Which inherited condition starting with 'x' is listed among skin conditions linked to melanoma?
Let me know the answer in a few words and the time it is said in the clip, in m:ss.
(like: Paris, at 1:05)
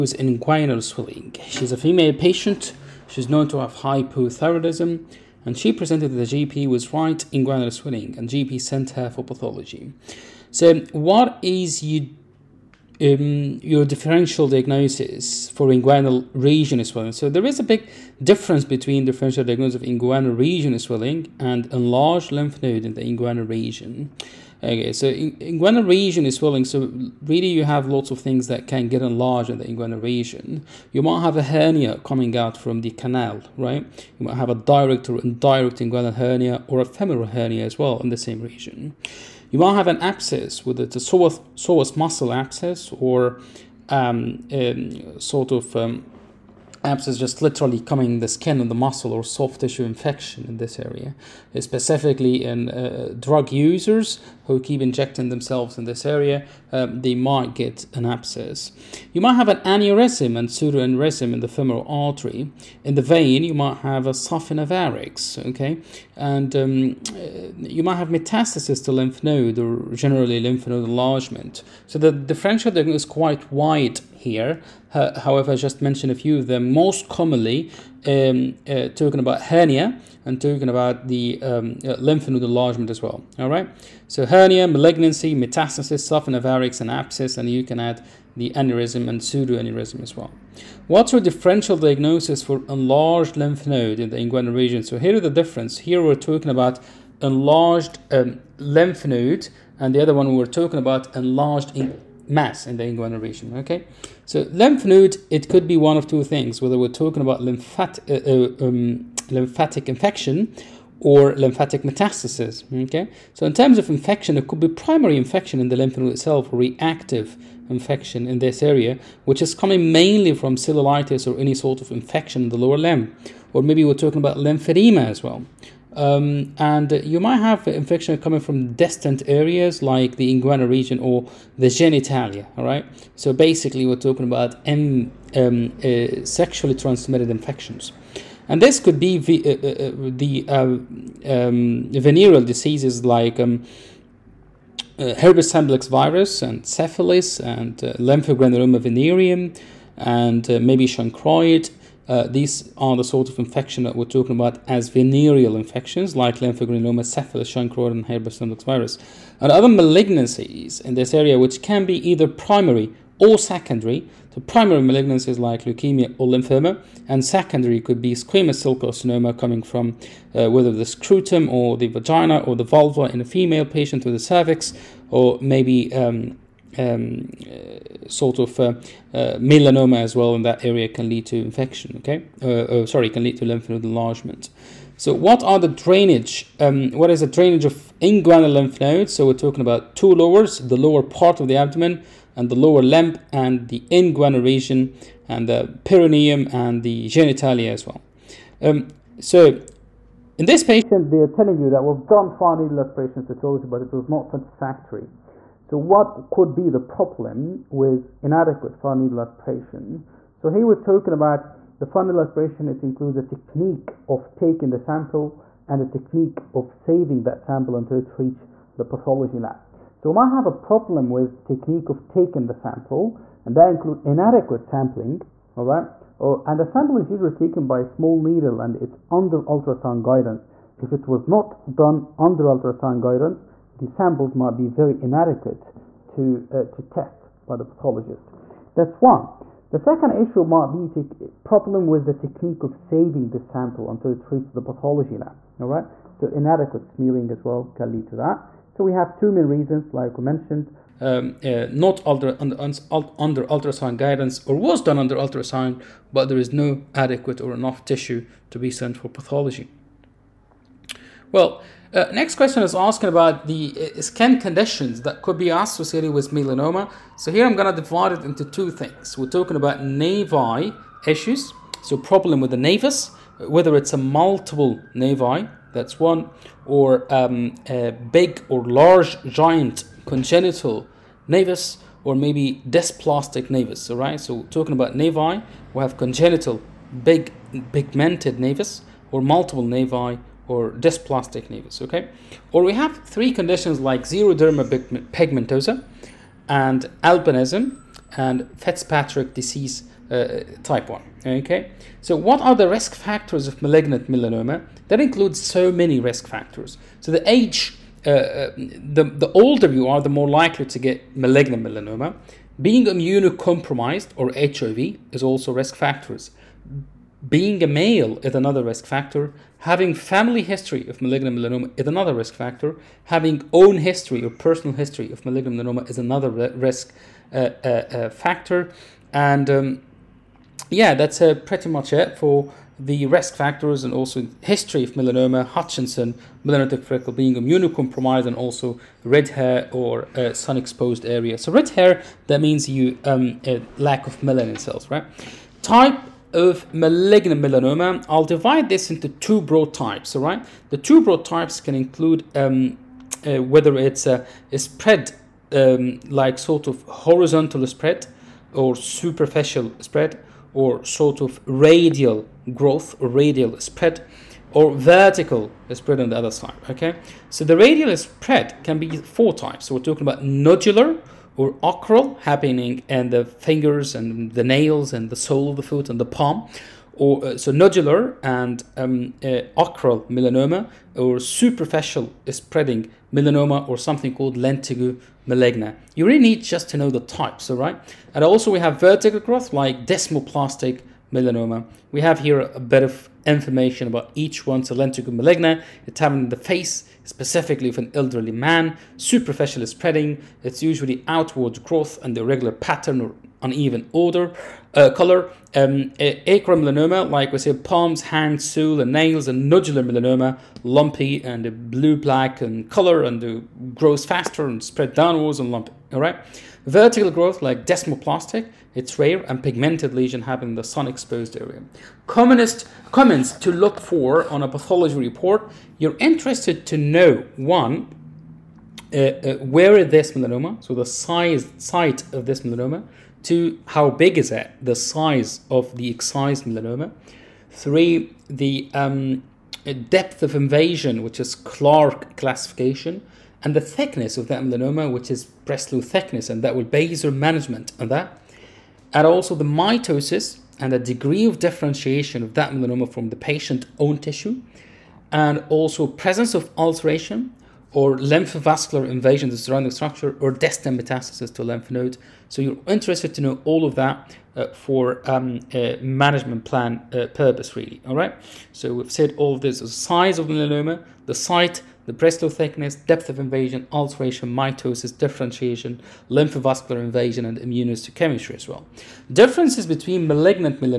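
Xeroderma pigmentosa, at 4:54.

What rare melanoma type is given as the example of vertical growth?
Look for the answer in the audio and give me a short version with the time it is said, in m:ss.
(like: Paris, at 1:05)
Desmoplastic melanoma, at 6:29.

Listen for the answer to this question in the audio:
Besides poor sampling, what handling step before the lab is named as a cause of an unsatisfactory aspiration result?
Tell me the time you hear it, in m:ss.
4:06.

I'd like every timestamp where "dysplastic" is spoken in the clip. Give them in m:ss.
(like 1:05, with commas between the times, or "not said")
4:42, 4:50.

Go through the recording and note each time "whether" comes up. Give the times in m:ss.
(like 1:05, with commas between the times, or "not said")
0:40, 1:46, 2:50, 4:33, 5:53.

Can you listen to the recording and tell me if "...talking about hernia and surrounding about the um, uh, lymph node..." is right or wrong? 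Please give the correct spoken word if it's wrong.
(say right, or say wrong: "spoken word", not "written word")
wrong: "talking", not "surrounding".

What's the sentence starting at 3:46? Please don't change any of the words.
Oh, and the sample is usually taken by a small needle and it's under ultrasound guidance.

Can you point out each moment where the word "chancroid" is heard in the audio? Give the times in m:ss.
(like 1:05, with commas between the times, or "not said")
2:30, 2:37.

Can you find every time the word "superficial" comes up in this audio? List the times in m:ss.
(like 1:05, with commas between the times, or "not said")
5:58, 6:21, 6:38.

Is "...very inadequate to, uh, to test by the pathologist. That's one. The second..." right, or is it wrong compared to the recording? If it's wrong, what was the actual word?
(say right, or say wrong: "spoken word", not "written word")
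right.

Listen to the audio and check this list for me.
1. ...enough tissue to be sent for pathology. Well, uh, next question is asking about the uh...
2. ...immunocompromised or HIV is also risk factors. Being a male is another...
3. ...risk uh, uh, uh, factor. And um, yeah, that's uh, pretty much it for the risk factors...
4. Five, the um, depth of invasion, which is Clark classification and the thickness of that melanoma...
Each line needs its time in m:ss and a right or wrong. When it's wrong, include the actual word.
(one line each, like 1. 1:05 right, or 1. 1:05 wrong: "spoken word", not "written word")
1. 4:17 right
2. 5:12 right
3. 5:26 right
4. 7:17 wrong: "Three", not "Five".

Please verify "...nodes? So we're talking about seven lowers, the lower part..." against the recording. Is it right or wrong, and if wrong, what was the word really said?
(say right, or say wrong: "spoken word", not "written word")
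wrong: "two", not "seven".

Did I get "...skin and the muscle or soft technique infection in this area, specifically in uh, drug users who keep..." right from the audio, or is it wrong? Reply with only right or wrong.
wrong.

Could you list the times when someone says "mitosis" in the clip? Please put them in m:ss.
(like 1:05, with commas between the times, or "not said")
7:29, 7:54.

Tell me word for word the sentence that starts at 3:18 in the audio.
Um, so in this patient, they are telling you that we've done fine needle aspiration cytology, but it was not satisfactory.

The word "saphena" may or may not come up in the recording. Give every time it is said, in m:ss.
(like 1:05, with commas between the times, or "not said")
1:26.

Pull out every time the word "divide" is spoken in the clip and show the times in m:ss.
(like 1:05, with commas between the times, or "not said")
4:27, 5:48.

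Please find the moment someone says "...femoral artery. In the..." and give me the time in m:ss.
1:01.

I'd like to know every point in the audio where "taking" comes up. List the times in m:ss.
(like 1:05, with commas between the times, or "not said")
3:34, 3:42.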